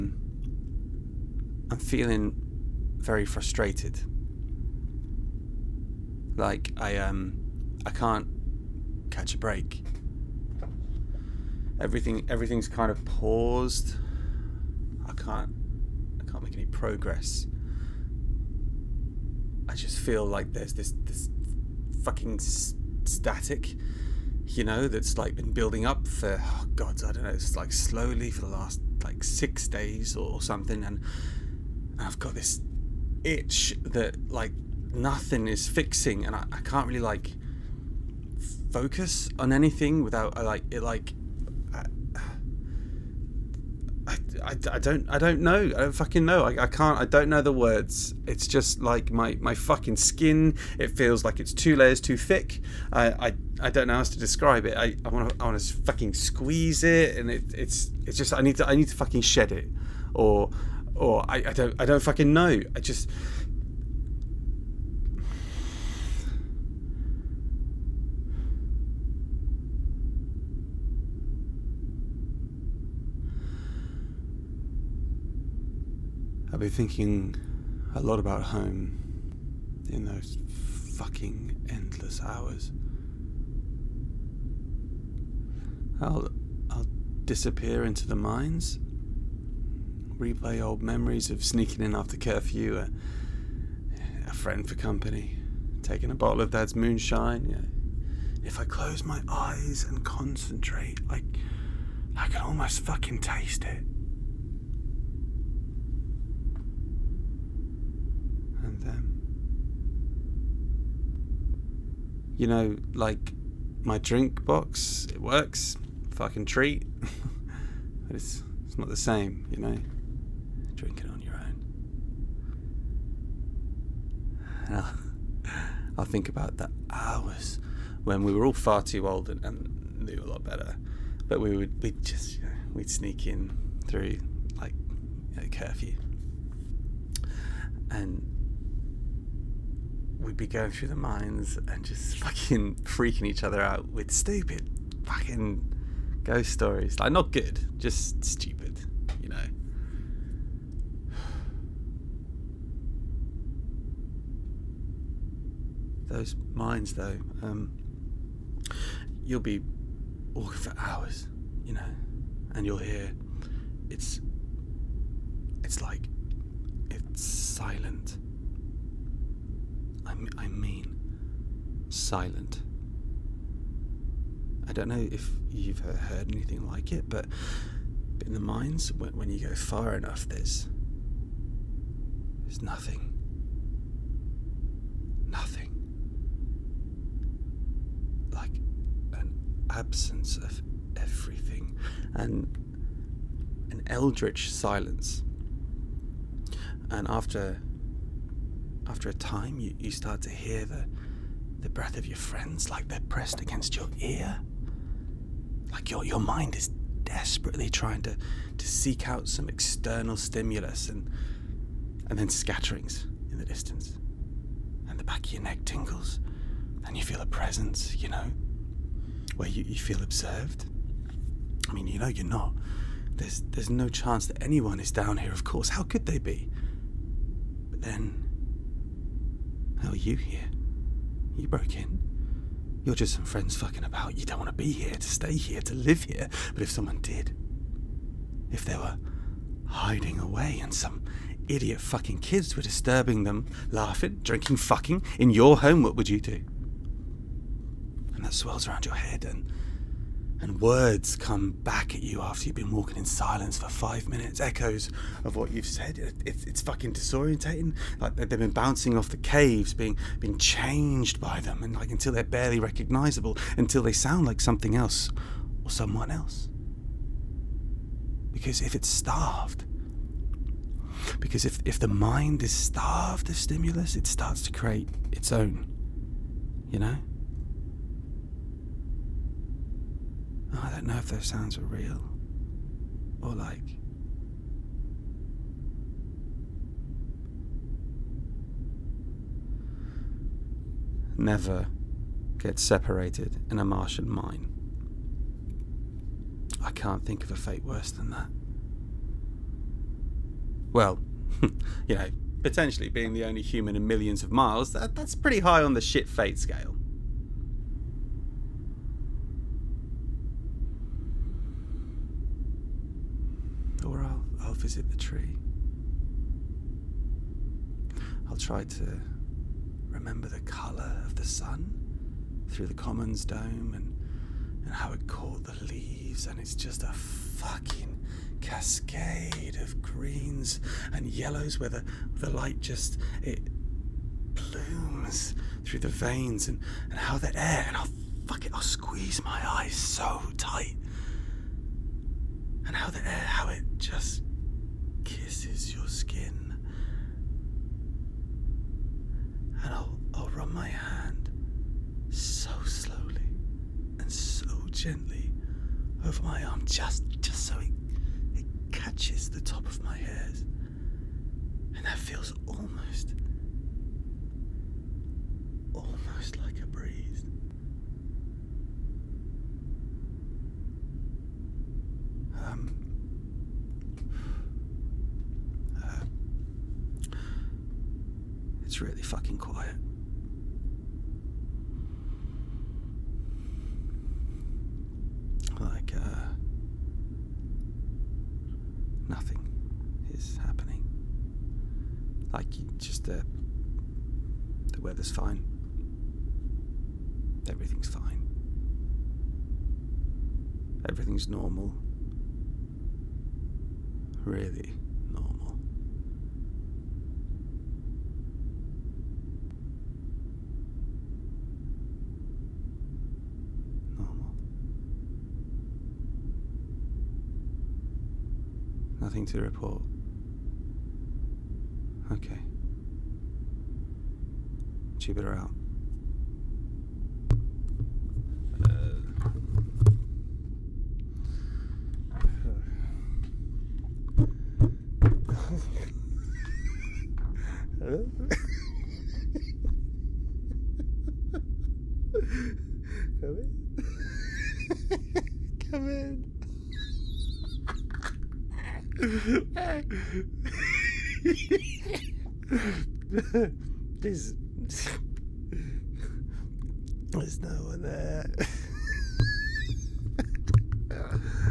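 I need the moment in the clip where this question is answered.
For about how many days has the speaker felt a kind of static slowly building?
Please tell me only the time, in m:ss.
0:29.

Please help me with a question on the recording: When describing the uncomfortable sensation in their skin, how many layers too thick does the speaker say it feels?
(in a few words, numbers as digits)
2.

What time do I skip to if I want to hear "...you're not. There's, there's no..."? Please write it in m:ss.
3:42.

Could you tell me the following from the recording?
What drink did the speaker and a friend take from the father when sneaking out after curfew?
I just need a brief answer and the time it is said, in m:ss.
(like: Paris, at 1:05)
moonshine, at 1:36.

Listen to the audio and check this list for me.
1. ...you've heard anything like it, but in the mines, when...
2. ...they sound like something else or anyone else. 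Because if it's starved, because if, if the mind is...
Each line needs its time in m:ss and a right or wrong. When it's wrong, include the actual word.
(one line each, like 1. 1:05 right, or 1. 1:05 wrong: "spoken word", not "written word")
1. 2:55 right
2. 4:23 wrong: "someone", not "anyone".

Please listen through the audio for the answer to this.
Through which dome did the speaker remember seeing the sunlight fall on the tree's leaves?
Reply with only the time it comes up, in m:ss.
5:22.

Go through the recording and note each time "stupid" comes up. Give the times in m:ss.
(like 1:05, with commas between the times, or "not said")
2:24, 2:28.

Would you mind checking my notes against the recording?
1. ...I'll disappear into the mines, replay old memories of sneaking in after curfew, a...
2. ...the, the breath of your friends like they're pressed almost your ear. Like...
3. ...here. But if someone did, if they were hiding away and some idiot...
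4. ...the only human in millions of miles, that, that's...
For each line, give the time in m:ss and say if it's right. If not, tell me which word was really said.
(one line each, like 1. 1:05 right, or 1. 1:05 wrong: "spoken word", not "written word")
1. 1:26 right
2. 3:20 wrong: "against", not "almost"
3. 3:56 right
4. 5:03 right.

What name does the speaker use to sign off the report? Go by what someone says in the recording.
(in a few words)
Jupiter.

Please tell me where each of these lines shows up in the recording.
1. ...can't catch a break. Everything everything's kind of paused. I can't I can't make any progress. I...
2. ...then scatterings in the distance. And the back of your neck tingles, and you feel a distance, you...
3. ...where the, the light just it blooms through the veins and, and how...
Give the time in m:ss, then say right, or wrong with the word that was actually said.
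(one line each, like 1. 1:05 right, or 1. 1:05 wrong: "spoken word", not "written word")
1. 0:07 right
2. 3:32 wrong: "presence", not "distance"
3. 5:31 right.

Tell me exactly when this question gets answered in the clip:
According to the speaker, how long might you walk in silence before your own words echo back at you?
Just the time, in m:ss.
4:13.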